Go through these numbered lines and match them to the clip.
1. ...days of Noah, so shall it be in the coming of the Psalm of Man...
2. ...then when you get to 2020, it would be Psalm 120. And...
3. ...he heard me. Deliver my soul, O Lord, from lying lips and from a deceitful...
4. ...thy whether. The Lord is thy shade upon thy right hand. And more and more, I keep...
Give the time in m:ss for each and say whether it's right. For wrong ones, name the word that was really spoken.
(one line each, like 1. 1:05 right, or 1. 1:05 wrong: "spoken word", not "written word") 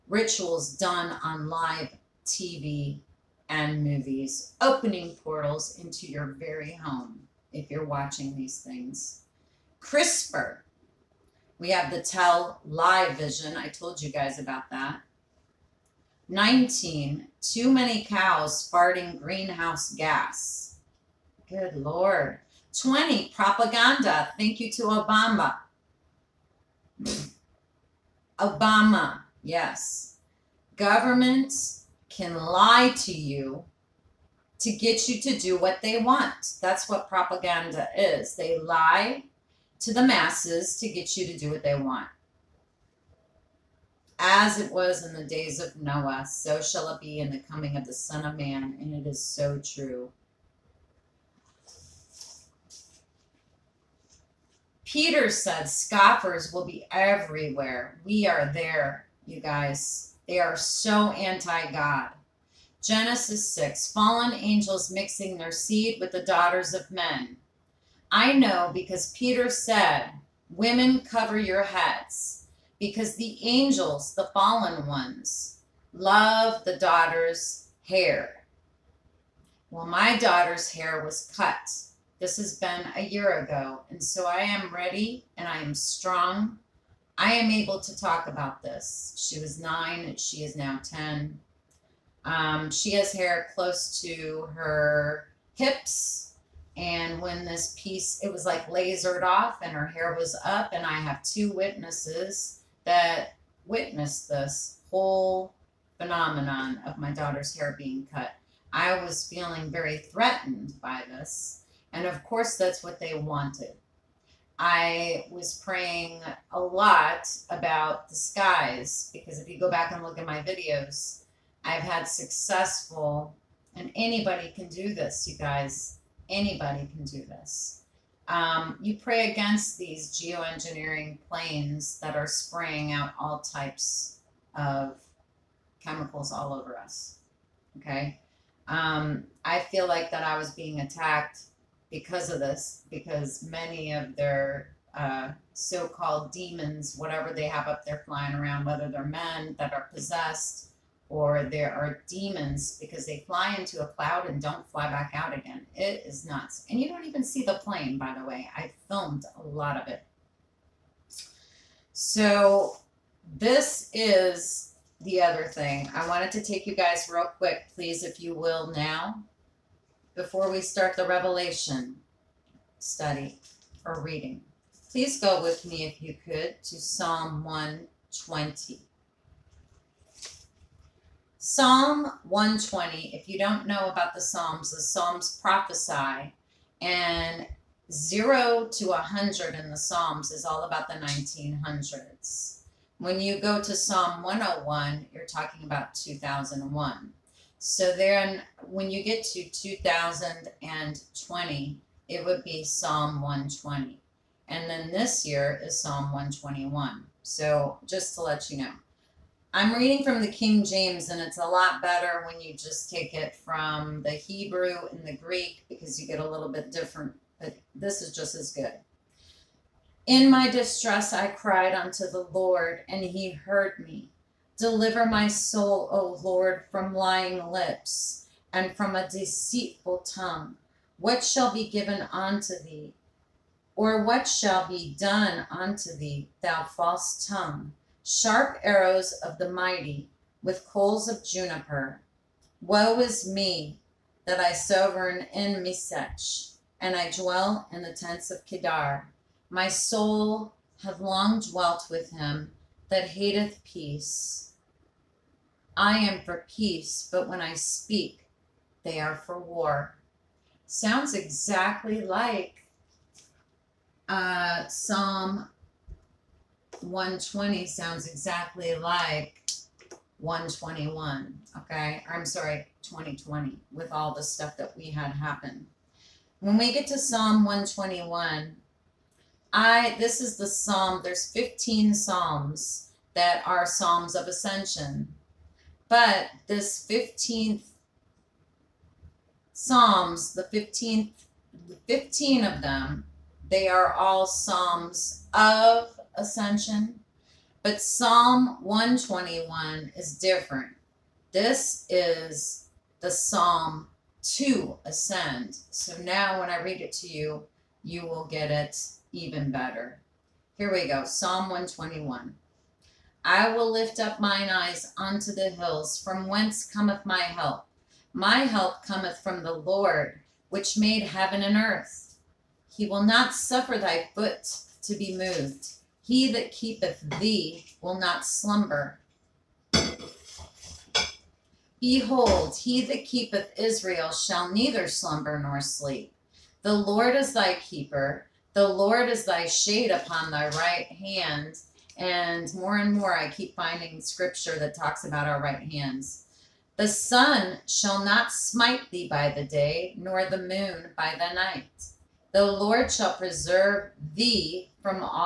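1. 0:45 wrong: "Son", not "Psalm"
2. 3:17 right
3. 3:43 right
4. 5:37 wrong: "keeper", not "whether".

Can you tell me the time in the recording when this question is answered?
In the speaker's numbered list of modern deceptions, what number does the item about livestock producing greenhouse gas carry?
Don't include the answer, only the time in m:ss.
0:16.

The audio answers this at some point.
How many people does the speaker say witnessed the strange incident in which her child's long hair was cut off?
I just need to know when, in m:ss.
1:41.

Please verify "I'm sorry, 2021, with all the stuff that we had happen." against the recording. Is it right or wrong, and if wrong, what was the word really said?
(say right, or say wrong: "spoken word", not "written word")
wrong: "2020", not "2021".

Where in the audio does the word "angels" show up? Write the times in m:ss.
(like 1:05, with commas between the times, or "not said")
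1:04, 1:13.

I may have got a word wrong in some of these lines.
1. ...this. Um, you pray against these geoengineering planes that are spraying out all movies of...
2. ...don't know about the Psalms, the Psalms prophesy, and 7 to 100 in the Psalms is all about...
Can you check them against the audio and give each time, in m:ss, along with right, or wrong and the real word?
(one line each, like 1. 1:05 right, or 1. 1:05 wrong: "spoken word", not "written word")
1. 2:07 wrong: "types", not "movies"
2. 3:03 wrong: "0", not "7".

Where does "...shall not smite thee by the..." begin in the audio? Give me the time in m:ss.
5:47.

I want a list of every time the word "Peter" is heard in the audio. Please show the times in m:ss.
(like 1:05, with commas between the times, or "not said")
0:54, 1:09.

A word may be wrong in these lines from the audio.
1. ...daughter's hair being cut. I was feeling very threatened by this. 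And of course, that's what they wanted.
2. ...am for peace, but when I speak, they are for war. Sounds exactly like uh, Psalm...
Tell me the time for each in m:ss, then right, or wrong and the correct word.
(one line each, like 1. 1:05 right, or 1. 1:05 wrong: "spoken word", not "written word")
1. 1:47 right
2. 4:15 right.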